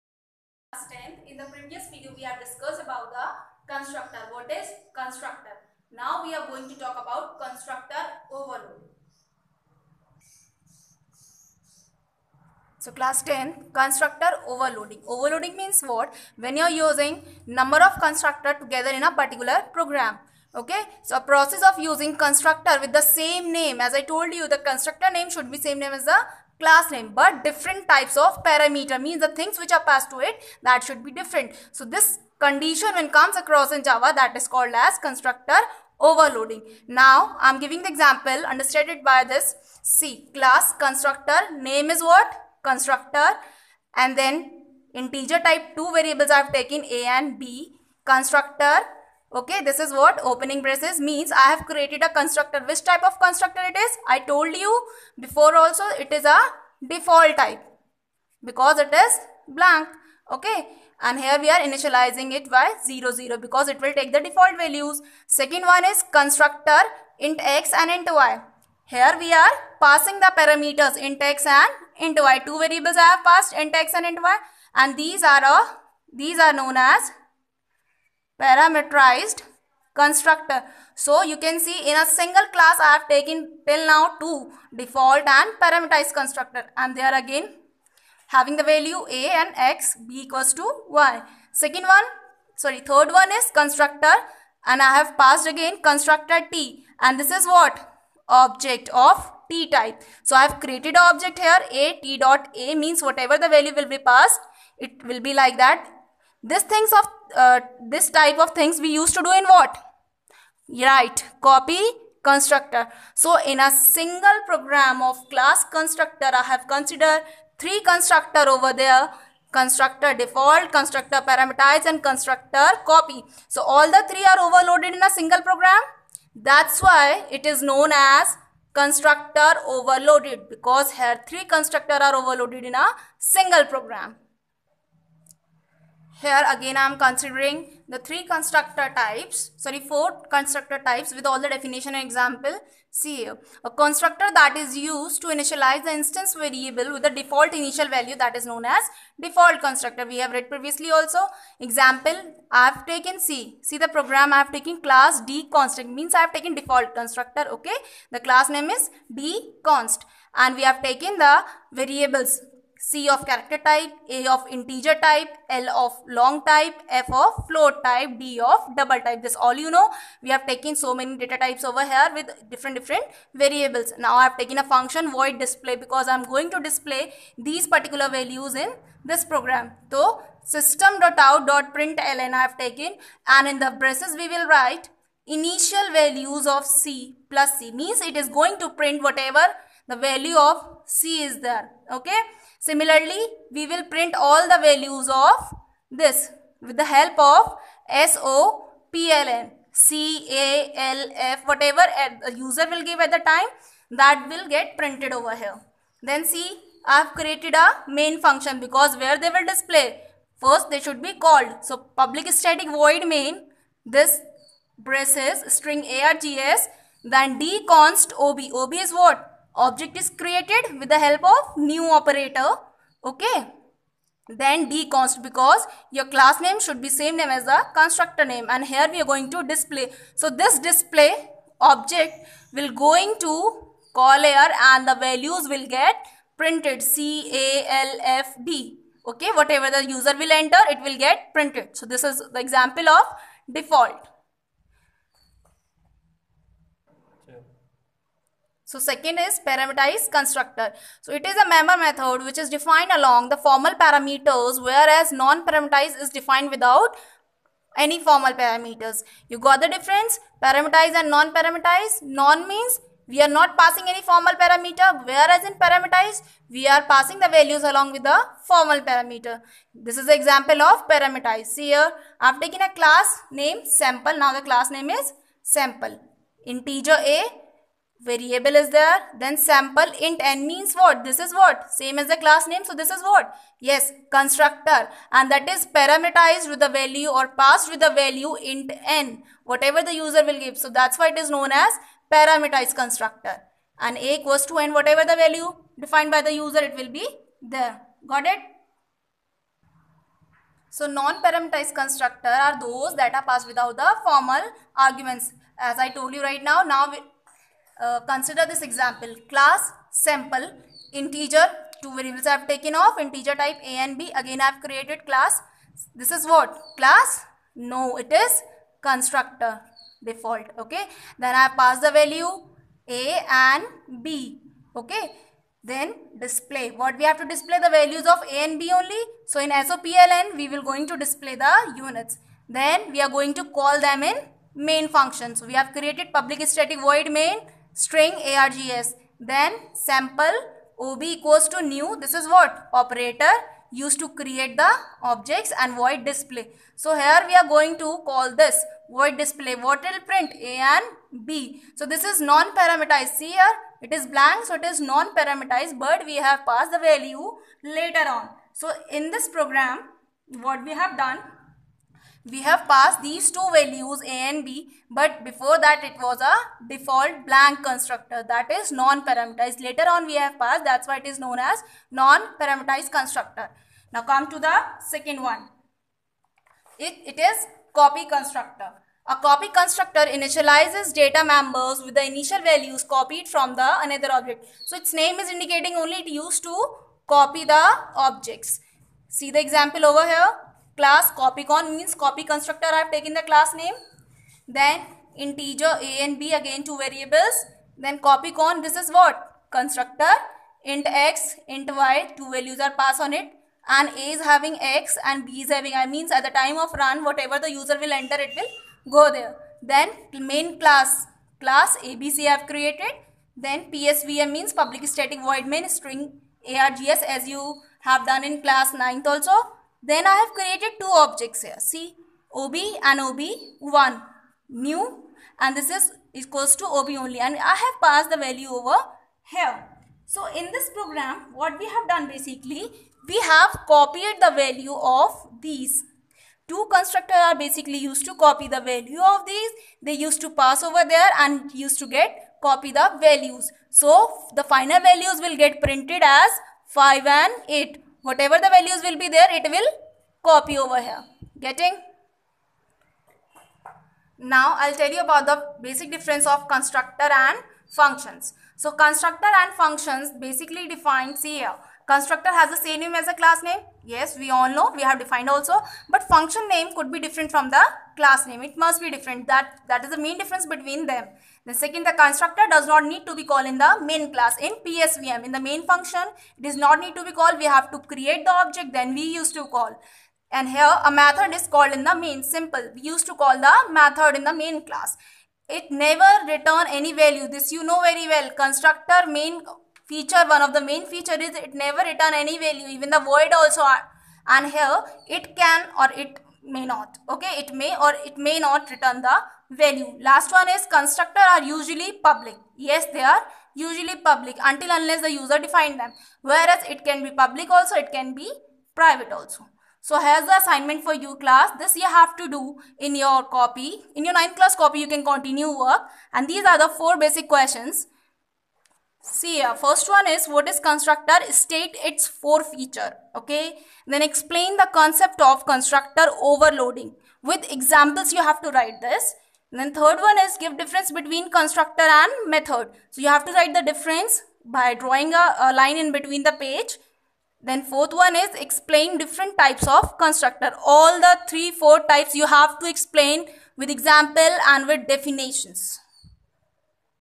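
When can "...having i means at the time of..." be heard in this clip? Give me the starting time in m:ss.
6:45.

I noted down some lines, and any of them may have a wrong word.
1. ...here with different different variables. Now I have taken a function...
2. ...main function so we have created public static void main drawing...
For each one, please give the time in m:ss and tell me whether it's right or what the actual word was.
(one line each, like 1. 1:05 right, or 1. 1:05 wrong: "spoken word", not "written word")
1. 2:51 right
2. 5:34 wrong: "string", not "drawing".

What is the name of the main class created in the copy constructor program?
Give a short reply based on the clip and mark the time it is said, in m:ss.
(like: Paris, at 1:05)
abc, at 6:51.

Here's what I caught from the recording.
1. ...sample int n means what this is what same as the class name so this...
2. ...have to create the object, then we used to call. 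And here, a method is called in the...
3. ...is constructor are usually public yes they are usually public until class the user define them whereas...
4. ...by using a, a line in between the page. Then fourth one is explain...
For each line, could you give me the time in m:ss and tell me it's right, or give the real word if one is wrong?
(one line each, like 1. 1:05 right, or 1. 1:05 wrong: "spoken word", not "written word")
1. 4:39 right
2. 7:57 right
3. 8:20 wrong: "unless", not "class"
4. 8:54 wrong: "drawing", not "using".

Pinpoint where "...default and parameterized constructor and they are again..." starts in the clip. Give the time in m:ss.
1:24.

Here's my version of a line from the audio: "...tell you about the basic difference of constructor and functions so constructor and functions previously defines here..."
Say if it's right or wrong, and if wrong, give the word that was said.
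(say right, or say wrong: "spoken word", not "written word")
wrong: "basically", not "previously".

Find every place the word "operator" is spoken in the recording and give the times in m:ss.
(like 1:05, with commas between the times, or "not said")
3:41, 5:42.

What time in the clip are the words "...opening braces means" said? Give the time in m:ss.
0:50.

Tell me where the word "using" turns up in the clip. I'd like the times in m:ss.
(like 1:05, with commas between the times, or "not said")
0:16, 0:21.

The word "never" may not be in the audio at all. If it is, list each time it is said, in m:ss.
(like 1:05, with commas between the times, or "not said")
8:05, 8:11.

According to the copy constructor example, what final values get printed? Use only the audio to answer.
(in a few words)
5 and 8.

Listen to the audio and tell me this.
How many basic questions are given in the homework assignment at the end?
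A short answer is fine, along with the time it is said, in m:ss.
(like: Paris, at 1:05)
4, at 8:36.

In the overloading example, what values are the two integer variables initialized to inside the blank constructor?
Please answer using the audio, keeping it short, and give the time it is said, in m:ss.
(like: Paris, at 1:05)
0, 0, at 1:02.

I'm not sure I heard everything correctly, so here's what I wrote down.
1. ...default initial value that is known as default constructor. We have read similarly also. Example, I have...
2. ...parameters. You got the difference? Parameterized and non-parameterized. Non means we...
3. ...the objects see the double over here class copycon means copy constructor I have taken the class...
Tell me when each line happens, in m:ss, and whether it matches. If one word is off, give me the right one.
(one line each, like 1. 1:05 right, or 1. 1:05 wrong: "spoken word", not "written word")
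1. 2:27 wrong: "previously", not "similarly"
2. 4:18 right
3. 6:27 wrong: "example", not "double".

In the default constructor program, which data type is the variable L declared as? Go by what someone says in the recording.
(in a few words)
long.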